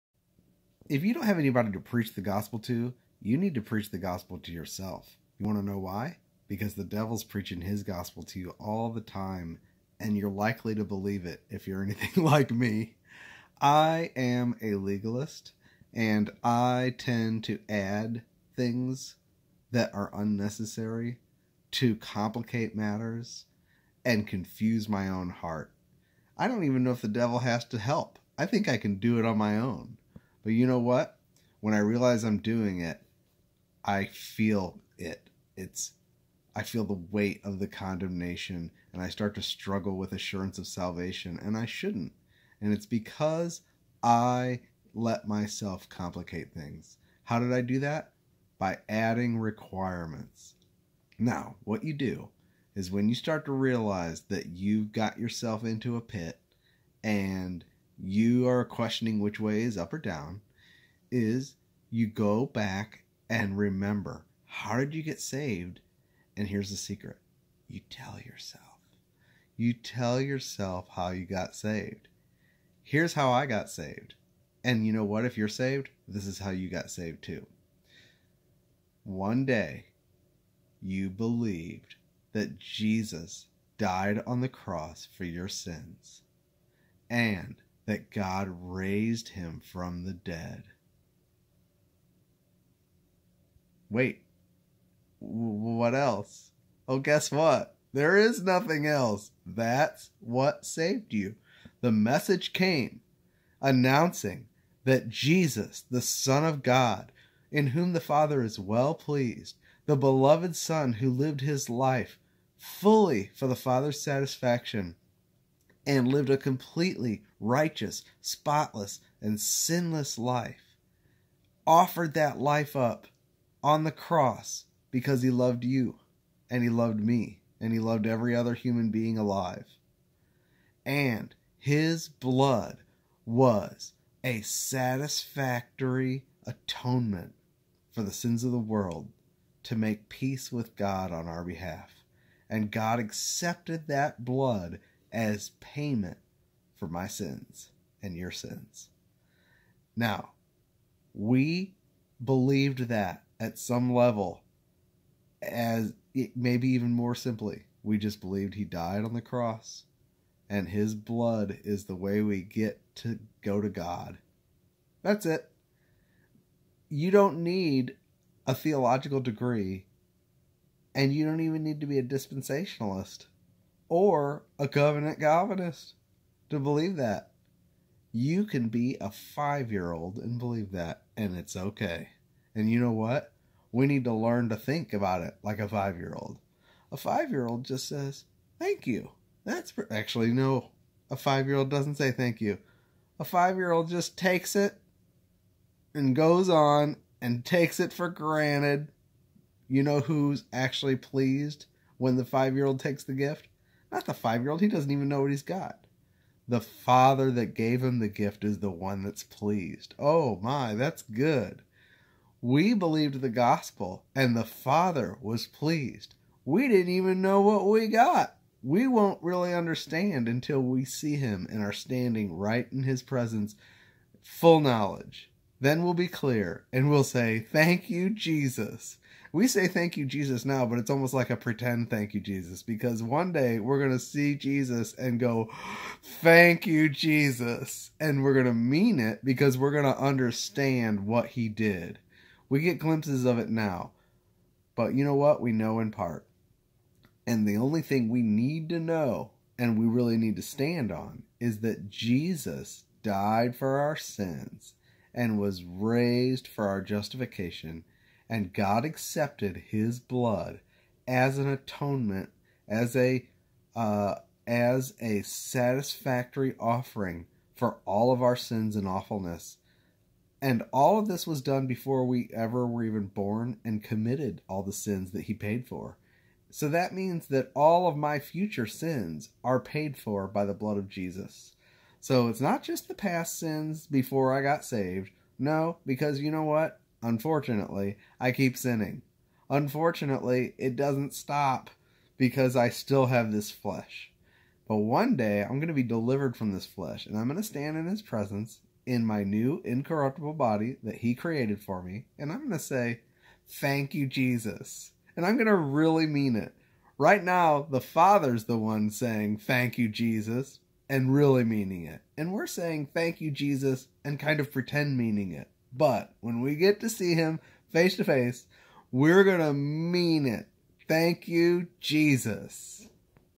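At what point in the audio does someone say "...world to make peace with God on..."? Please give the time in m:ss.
2:18.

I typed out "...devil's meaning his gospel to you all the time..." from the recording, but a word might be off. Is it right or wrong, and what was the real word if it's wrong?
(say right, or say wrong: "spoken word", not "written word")
wrong: "preaching", not "meaning".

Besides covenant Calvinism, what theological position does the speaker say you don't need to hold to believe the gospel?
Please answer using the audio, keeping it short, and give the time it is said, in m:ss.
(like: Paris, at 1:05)
dispensationalist, at 2:52.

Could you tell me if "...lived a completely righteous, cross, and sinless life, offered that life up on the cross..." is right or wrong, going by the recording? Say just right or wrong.
wrong.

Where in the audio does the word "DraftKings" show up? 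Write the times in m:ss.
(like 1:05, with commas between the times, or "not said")
not said.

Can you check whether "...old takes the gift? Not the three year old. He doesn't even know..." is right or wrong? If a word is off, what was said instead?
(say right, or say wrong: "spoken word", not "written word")
wrong: "five", not "three".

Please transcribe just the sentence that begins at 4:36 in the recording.
So that means that all of my future sins are paid for by the blood of Jesus.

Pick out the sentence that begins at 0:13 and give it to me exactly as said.
I am a legalist, and I tend to add things that are unnecessary to complicate matters and confuse my own heart.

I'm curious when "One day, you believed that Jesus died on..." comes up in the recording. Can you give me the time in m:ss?
1:19.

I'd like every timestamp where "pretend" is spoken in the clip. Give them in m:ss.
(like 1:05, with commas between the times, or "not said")
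3:51, 5:14.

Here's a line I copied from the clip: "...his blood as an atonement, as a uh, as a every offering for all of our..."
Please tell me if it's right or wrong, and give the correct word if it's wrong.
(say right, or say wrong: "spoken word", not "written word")
wrong: "satisfactory", not "every".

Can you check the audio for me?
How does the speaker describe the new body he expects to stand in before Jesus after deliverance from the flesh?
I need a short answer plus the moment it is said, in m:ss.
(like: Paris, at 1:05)
incorruptible, at 4:59.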